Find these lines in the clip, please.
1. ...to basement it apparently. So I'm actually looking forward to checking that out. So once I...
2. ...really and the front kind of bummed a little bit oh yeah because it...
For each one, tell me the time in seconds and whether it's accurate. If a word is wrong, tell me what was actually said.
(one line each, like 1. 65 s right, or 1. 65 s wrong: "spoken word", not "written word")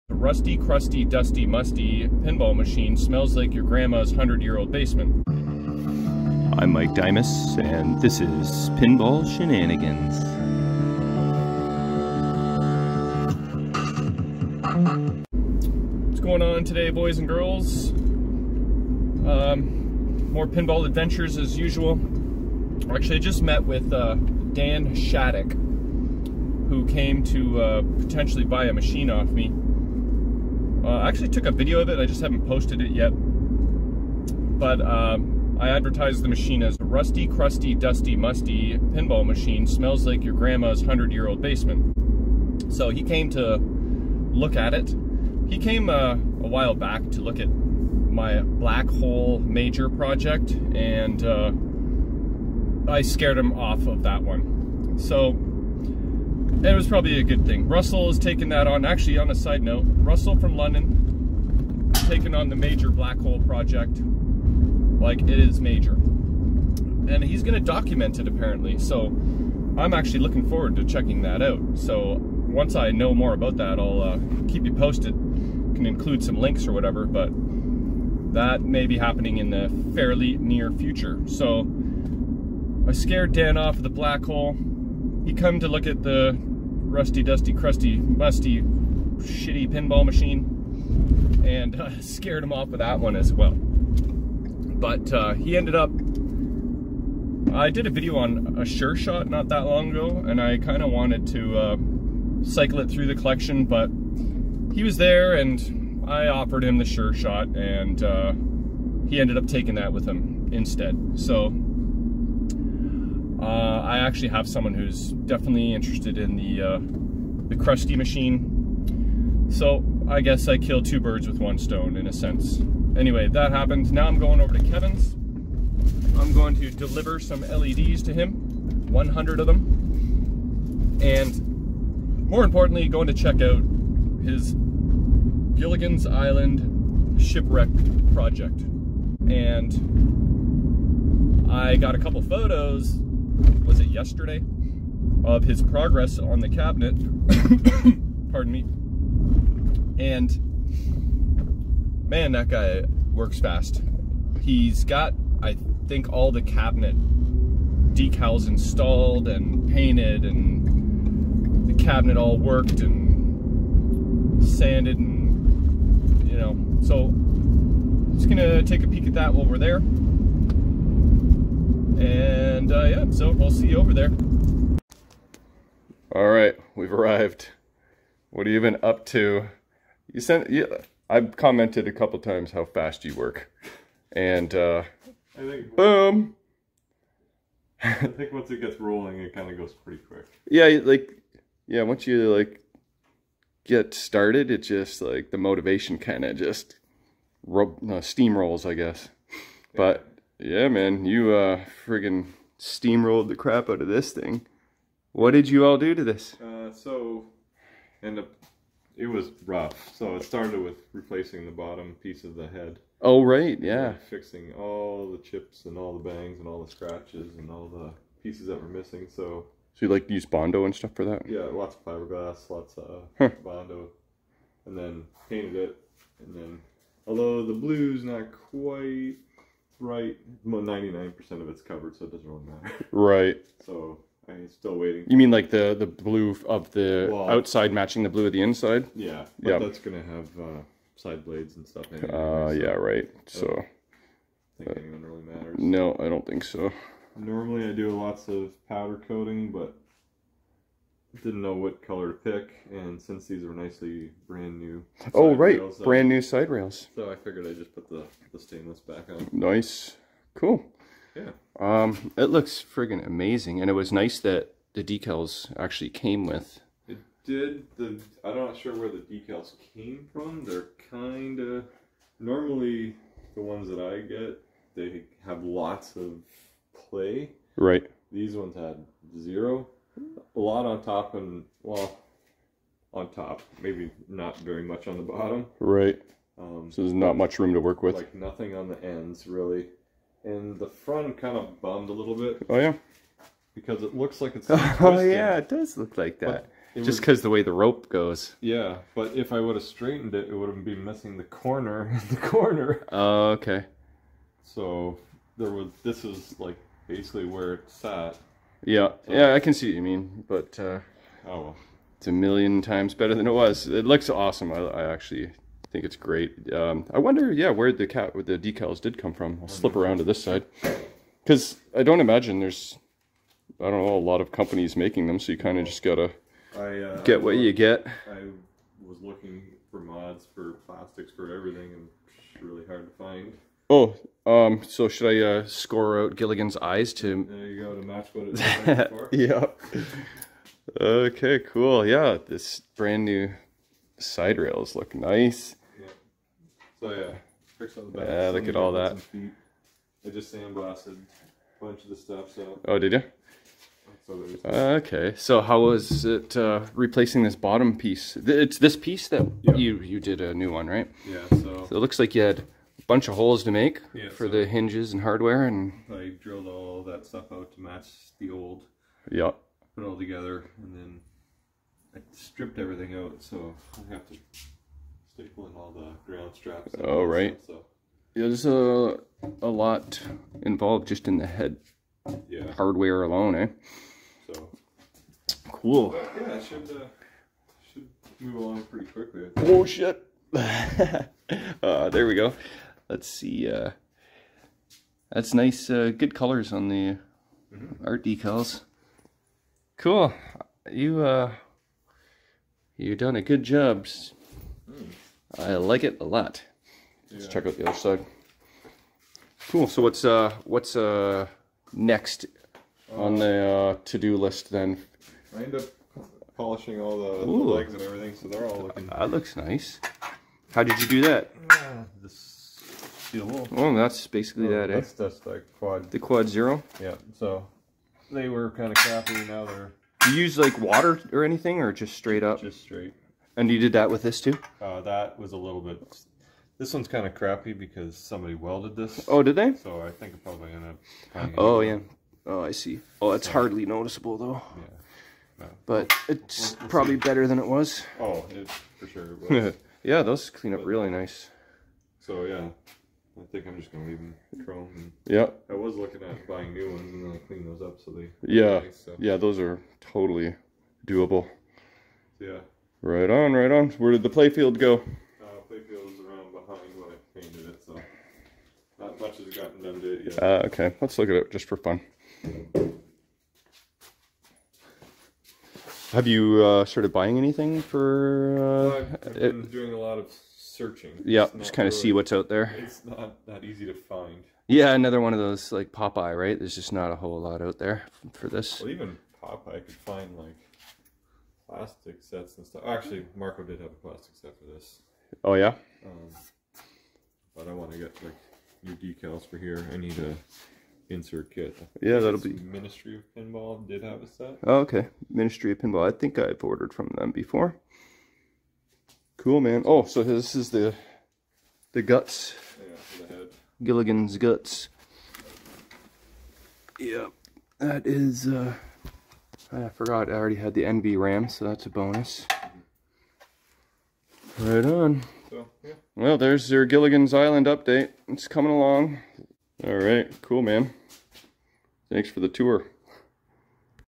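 1. 67 s wrong: "document", not "basement"
2. 289 s right.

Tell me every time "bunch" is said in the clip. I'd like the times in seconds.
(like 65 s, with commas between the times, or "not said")
351 s, 362 s.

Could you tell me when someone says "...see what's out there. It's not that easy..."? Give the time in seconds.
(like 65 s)
481 s.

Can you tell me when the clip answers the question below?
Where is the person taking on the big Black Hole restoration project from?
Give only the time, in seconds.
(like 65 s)
60 s.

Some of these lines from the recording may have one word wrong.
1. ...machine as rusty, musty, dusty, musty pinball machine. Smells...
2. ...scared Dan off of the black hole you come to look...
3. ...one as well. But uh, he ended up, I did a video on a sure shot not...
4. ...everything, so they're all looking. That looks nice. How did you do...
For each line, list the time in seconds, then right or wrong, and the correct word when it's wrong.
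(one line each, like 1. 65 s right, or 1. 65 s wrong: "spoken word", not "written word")
1. 36 s wrong: "crusty", not "musty"
2. 82 s right
3. 92 s right
4. 417 s right.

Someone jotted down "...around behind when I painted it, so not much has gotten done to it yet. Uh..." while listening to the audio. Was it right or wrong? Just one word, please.
right.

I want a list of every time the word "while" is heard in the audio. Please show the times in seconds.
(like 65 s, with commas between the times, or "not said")
46 s, 169 s.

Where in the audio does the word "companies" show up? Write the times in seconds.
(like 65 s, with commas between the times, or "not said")
324 s.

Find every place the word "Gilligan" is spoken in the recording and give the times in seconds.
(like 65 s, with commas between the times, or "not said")
135 s, 336 s, 513 s, 526 s.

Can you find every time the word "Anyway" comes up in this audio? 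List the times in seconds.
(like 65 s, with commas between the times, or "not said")
122 s, 241 s.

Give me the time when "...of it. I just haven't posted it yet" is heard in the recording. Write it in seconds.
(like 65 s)
31 s.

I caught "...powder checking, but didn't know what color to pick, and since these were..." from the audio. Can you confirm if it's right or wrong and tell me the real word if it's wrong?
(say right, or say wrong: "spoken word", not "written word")
wrong: "coating", not "checking".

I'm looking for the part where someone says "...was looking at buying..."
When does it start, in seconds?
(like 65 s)
455 s.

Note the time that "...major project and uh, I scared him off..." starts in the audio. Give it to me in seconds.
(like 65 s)
49 s.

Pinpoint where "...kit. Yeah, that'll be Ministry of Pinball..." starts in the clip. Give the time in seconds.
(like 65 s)
501 s.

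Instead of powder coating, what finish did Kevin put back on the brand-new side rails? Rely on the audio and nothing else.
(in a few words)
stainless.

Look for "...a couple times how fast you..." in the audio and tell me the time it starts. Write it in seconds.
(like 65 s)
181 s.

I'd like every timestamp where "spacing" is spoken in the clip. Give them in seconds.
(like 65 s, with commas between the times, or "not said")
not said.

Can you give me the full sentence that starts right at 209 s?
So it started with replacing the bottom piece of the head.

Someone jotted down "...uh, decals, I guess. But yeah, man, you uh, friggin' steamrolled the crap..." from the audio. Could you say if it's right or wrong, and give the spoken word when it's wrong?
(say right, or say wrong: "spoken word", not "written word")
wrong: "steamrolls", not "decals".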